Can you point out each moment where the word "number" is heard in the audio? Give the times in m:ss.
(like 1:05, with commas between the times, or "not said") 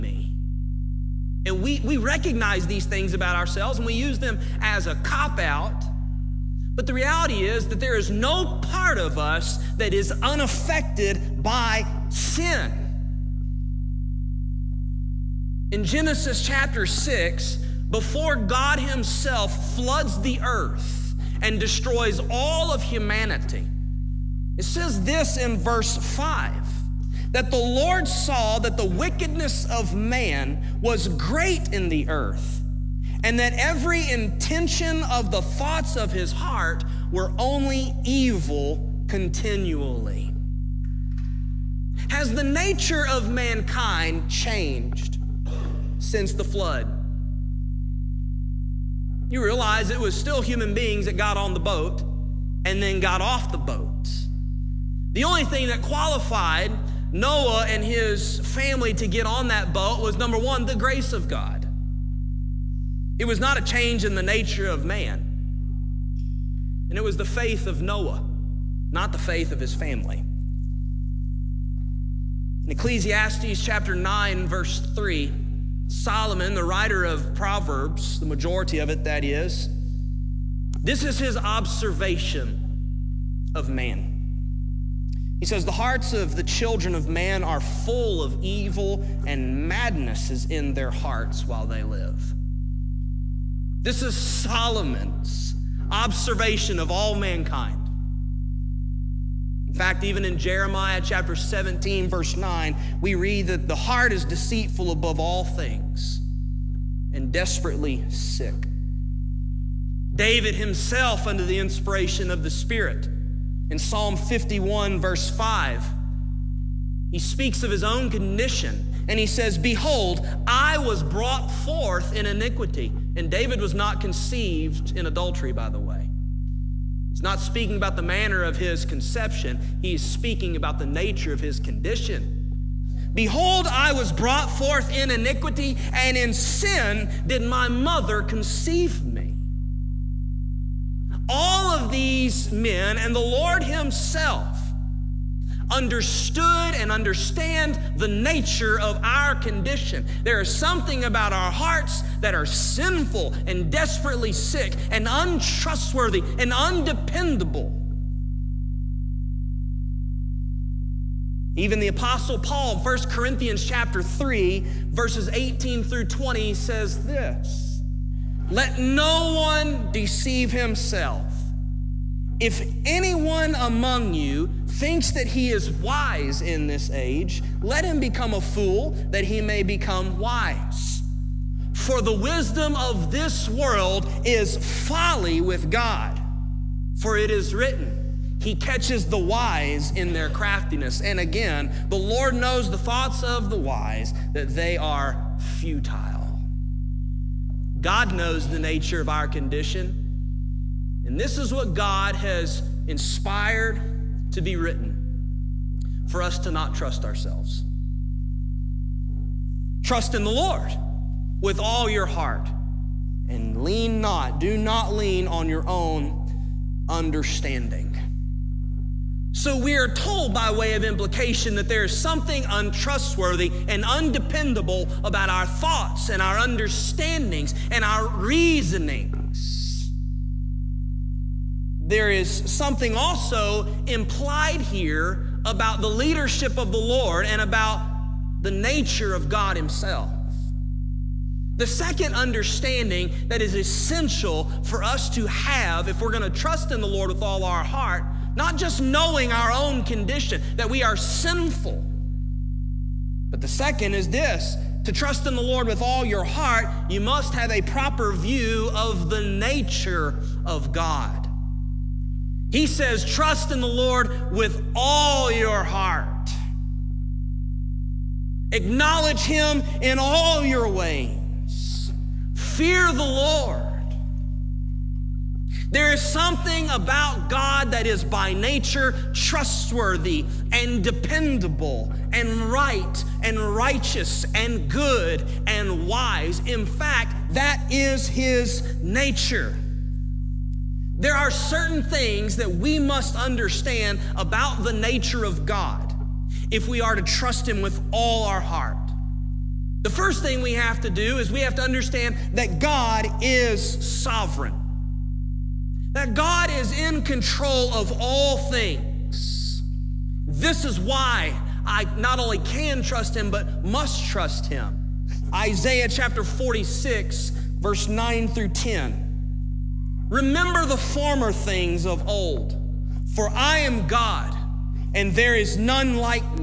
1:00.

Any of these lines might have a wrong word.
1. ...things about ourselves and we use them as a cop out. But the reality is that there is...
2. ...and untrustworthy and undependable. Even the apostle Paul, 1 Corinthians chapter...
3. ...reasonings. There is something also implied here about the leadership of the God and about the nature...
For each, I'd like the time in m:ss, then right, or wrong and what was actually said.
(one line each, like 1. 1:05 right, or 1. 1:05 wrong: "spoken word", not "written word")
1. 0:02 right
2. 2:34 right
3. 3:48 wrong: "Lord", not "God".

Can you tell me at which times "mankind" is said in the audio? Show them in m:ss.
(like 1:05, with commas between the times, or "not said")
0:43, 1:37.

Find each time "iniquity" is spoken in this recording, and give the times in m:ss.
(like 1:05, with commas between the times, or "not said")
2:02, 2:15.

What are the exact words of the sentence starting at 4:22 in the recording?
He says, trust in the Lord with all your heart.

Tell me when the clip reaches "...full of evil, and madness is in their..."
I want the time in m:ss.
1:27.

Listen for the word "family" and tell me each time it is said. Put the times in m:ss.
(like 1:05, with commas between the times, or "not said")
0:58, 1:09.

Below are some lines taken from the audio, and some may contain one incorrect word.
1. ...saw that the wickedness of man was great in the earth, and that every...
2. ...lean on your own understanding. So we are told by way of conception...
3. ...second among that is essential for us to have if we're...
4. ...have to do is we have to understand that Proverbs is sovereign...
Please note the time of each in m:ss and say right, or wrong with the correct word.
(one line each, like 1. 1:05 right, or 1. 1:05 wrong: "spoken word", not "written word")
1. 0:28 right
2. 3:34 wrong: "implication", not "conception"
3. 4:01 wrong: "understanding", not "among"
4. 5:00 wrong: "God", not "Proverbs".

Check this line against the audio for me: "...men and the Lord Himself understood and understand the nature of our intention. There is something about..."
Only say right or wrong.
wrong.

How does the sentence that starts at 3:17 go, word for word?
God knows the nature of our condition.